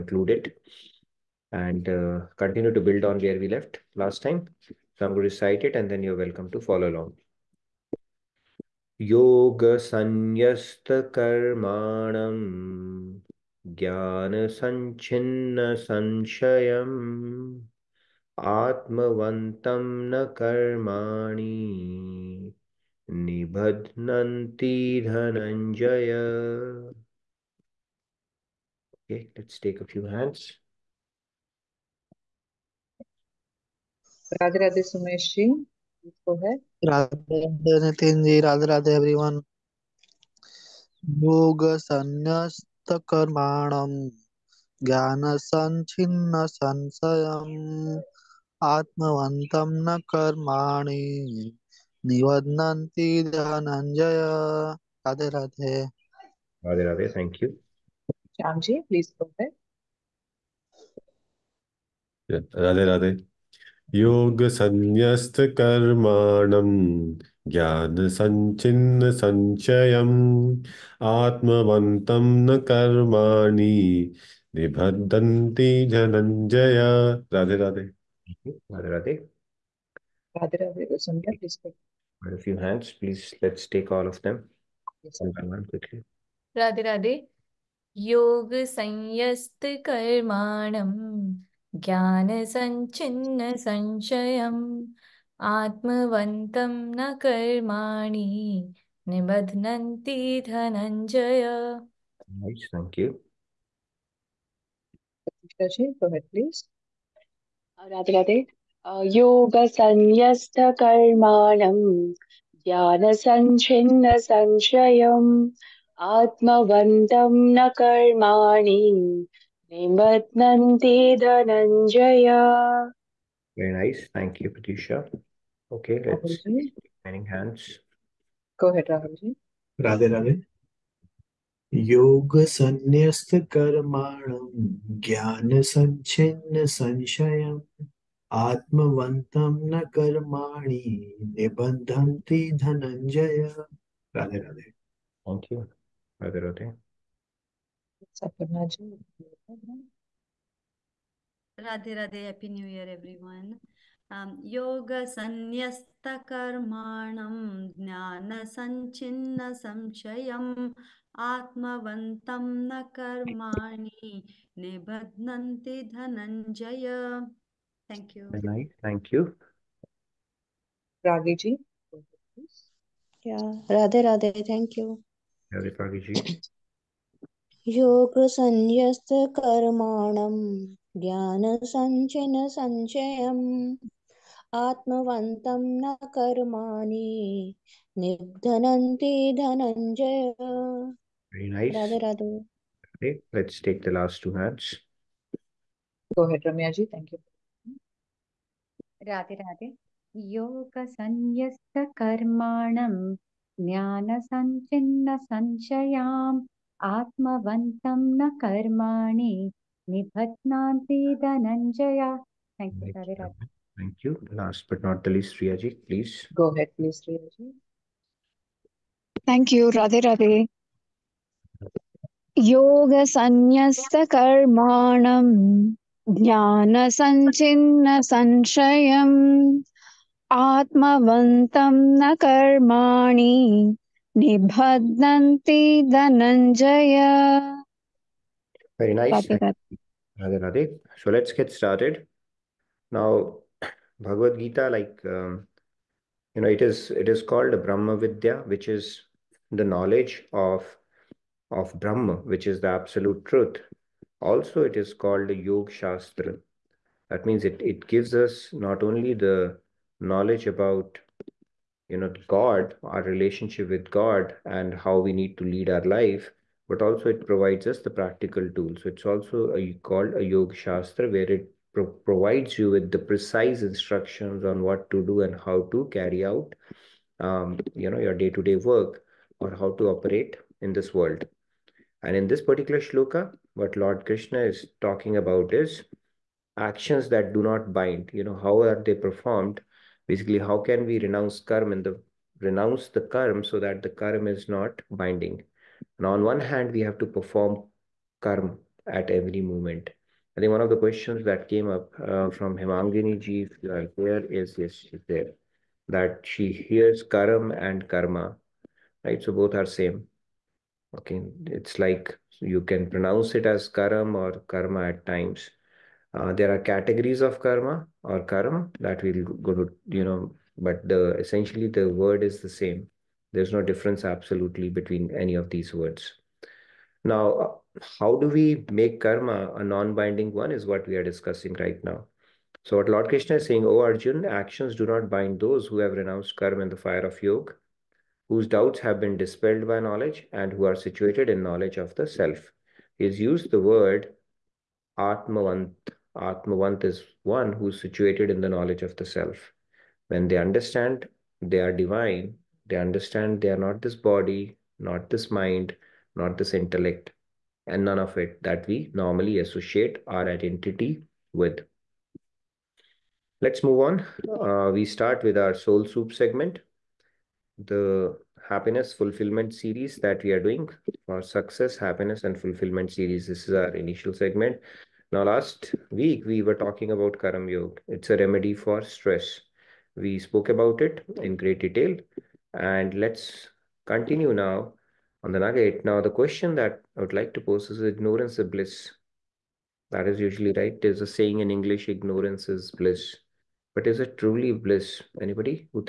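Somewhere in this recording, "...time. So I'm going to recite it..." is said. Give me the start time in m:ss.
0:04.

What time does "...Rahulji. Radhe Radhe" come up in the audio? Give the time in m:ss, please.
2:08.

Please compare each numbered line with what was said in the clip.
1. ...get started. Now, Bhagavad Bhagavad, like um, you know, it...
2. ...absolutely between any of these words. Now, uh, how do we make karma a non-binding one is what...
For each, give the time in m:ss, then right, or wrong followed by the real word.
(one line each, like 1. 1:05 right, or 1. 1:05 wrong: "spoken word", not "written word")
1. 4:01 wrong: "Gita", not "Bhagavad"
2. 5:24 right.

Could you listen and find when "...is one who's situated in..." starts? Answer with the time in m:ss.
5:46.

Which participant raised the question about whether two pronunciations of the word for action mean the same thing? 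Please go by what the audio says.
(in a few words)
Himangini ji.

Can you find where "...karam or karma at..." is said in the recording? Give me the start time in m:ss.
5:13.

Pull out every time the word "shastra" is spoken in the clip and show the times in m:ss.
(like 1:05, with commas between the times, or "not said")
4:15, 4:30.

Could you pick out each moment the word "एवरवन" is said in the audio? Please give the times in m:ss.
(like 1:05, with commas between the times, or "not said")
0:38, 2:32.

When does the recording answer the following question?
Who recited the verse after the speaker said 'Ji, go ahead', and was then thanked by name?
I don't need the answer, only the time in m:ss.
2:04.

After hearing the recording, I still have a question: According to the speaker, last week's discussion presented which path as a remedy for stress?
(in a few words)
Karam Yoga.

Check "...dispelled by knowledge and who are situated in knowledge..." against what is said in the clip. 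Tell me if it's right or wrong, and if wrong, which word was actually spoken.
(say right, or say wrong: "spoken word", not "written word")
right.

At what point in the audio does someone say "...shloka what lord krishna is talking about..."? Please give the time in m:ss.
4:42.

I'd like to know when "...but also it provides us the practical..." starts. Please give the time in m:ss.
4:26.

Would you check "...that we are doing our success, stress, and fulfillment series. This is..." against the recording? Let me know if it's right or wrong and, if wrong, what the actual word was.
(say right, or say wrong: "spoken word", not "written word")
wrong: "happiness", not "stress".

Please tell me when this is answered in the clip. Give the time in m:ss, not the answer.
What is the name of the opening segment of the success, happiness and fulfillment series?
6:05.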